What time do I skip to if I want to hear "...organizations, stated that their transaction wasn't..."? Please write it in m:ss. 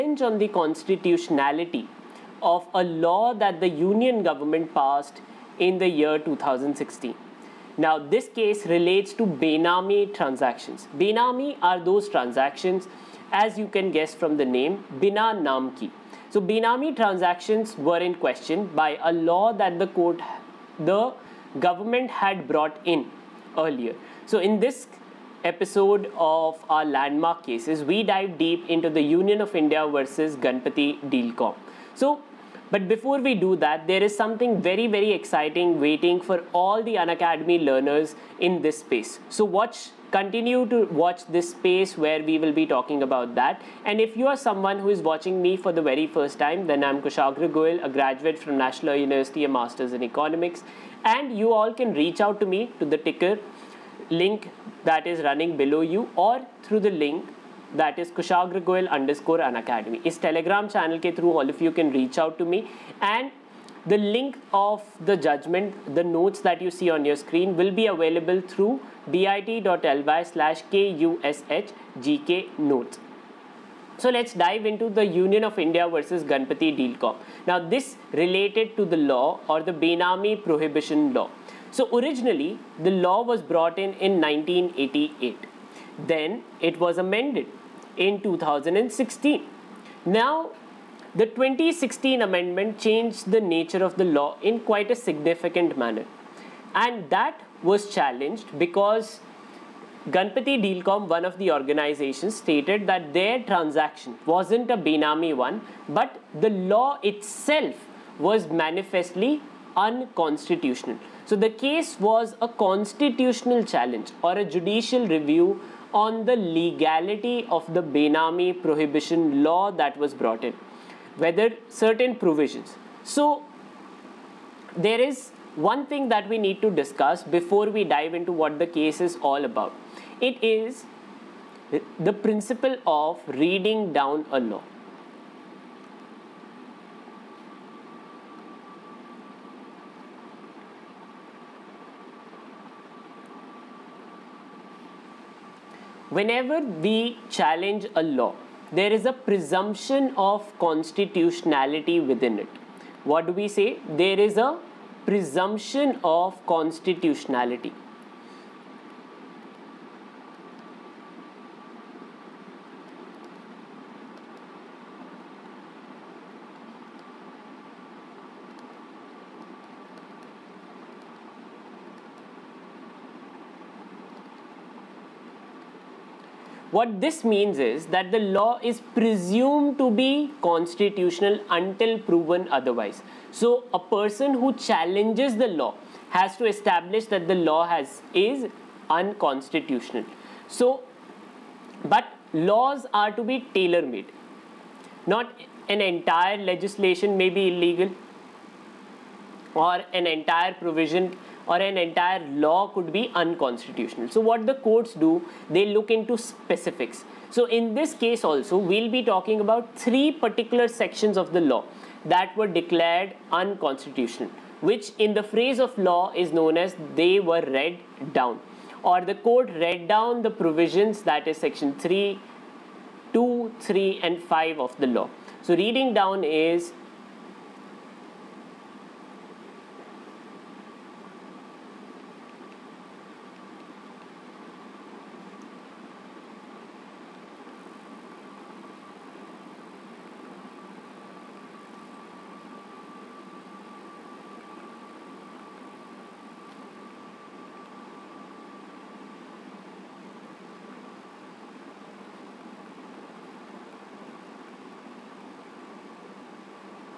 1:41.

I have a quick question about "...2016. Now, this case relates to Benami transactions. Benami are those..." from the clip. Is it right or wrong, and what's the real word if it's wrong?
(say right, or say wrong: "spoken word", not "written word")
right.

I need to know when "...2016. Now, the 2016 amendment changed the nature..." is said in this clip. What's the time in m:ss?
1:28.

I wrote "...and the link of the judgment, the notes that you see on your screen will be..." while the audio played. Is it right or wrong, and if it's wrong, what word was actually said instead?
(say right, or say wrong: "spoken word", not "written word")
right.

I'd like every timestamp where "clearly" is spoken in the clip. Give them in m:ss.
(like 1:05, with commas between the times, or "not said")
not said.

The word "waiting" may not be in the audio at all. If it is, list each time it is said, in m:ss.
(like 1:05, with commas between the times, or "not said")
0:35.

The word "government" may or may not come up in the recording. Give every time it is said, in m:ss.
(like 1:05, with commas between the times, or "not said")
0:04, 0:21.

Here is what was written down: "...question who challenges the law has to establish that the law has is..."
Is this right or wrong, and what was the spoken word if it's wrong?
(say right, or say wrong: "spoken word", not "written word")
wrong: "person", not "question".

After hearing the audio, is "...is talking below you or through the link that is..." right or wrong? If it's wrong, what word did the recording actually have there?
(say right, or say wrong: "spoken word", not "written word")
wrong: "running", not "talking".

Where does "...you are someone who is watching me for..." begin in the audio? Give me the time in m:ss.
0:44.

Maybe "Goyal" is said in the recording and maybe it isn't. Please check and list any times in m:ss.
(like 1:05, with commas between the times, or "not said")
0:47, 0:58.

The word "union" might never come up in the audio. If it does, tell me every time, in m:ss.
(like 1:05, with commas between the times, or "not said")
0:03, 0:29, 1:15.